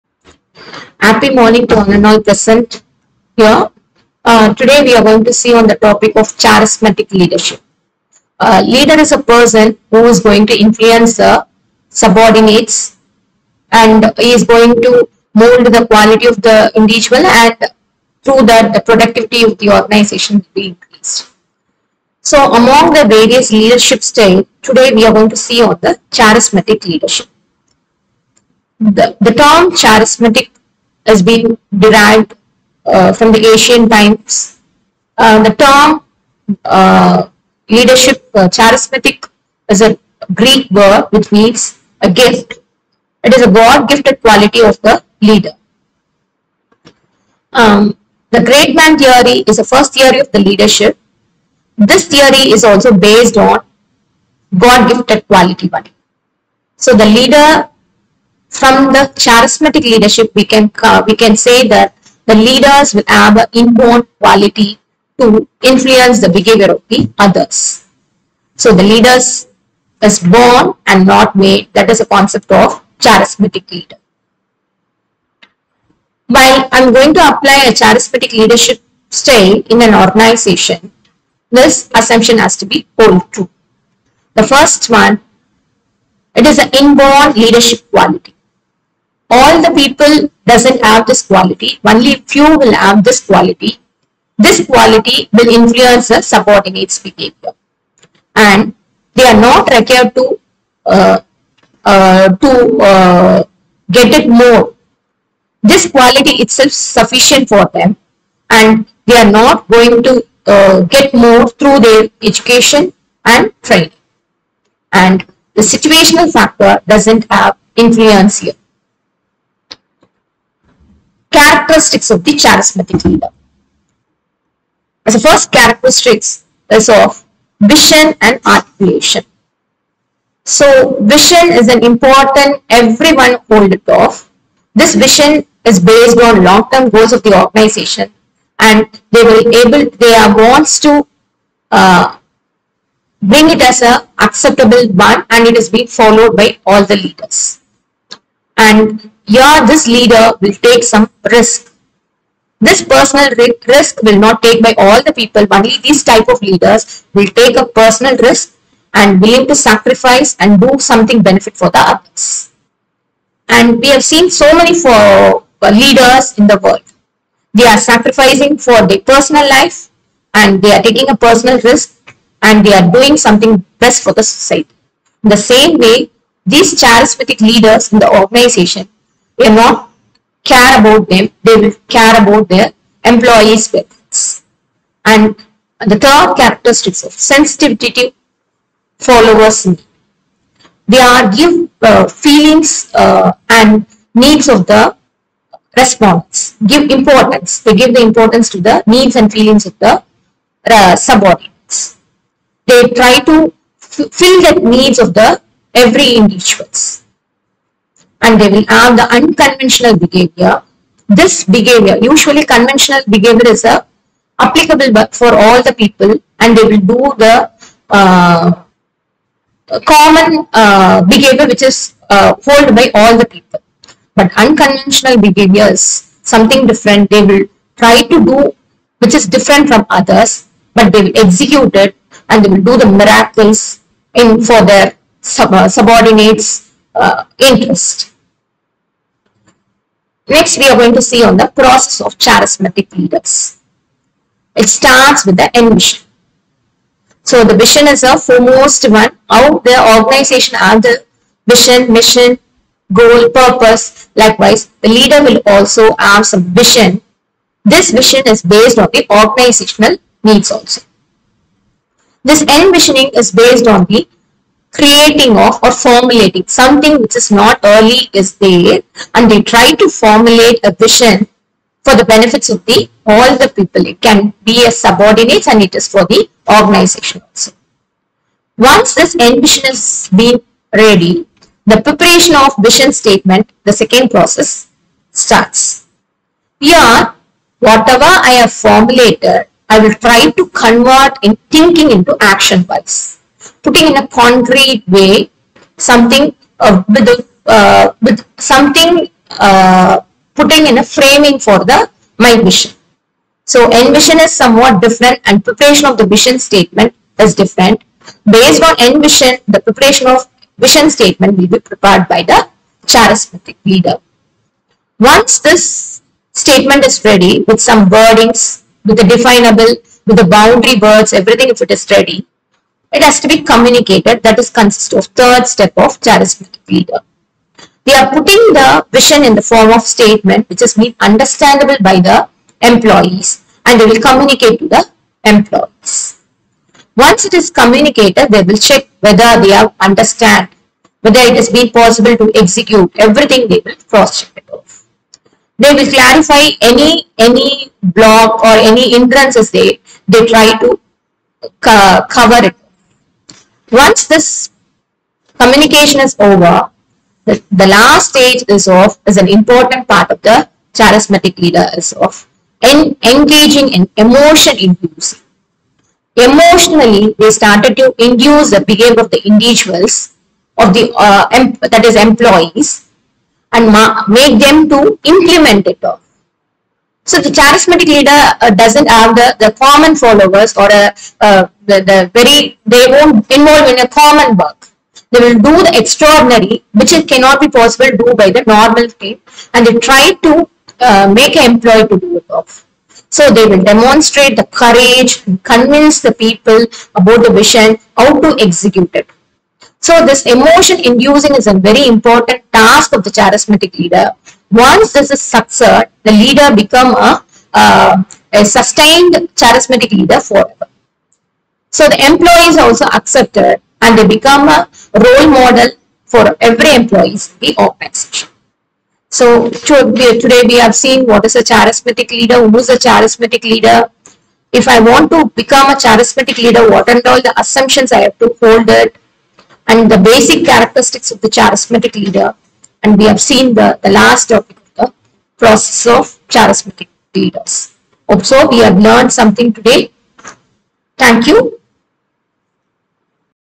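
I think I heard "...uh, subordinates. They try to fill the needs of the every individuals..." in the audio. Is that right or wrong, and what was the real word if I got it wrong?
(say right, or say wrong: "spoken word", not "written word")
right.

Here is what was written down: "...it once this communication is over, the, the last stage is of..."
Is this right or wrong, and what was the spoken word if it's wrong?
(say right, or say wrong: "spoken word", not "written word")
right.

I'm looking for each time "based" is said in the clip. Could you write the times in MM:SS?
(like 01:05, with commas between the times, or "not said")
00:52, 02:15, 04:18, 04:23, 05:08.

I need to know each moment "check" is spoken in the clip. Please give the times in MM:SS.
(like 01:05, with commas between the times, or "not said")
05:38, 05:44.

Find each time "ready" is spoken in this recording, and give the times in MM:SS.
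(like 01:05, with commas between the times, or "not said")
04:40, 05:17, 05:21.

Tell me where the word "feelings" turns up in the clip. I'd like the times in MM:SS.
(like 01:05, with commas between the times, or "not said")
03:12, 03:19.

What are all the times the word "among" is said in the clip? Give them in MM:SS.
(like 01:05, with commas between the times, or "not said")
00:22.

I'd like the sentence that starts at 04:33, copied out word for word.
It can be a subordinates and it is for the organization also.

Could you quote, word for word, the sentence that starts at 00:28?
The, the term charismatic has been derived uh, from the Asian times.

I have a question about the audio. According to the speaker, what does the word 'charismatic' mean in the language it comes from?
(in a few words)
A gift.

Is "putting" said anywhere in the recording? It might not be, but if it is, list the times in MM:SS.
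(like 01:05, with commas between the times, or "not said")
04:53, 05:00, 05:28.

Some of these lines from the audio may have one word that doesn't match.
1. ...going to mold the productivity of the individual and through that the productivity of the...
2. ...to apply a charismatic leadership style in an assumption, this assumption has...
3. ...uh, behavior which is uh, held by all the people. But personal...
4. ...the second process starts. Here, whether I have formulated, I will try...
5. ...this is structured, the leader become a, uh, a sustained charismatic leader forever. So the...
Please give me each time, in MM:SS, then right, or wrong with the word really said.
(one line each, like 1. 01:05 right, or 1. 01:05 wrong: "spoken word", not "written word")
1. 00:14 wrong: "quality", not "productivity"
2. 01:17 wrong: "organization", not "assumption"
3. 03:40 wrong: "unconventional", not "personal"
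4. 04:43 wrong: "whatever", not "whether"
5. 06:44 right.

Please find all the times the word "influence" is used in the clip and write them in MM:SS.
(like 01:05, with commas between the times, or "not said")
00:10, 01:05, 01:35, 01:57.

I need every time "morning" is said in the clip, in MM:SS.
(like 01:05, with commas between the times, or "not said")
00:01.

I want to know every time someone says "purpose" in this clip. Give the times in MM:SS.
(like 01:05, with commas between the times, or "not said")
04:13.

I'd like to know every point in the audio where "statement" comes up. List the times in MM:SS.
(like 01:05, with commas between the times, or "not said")
04:42, 05:06, 05:10, 05:16, 05:29.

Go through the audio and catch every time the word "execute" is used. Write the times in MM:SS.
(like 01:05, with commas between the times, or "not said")
03:51, 05:42, 06:38.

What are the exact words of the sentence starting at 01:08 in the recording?
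So the leaders is born and not made.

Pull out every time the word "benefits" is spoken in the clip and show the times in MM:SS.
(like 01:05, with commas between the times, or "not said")
02:41, 03:03, 04:32.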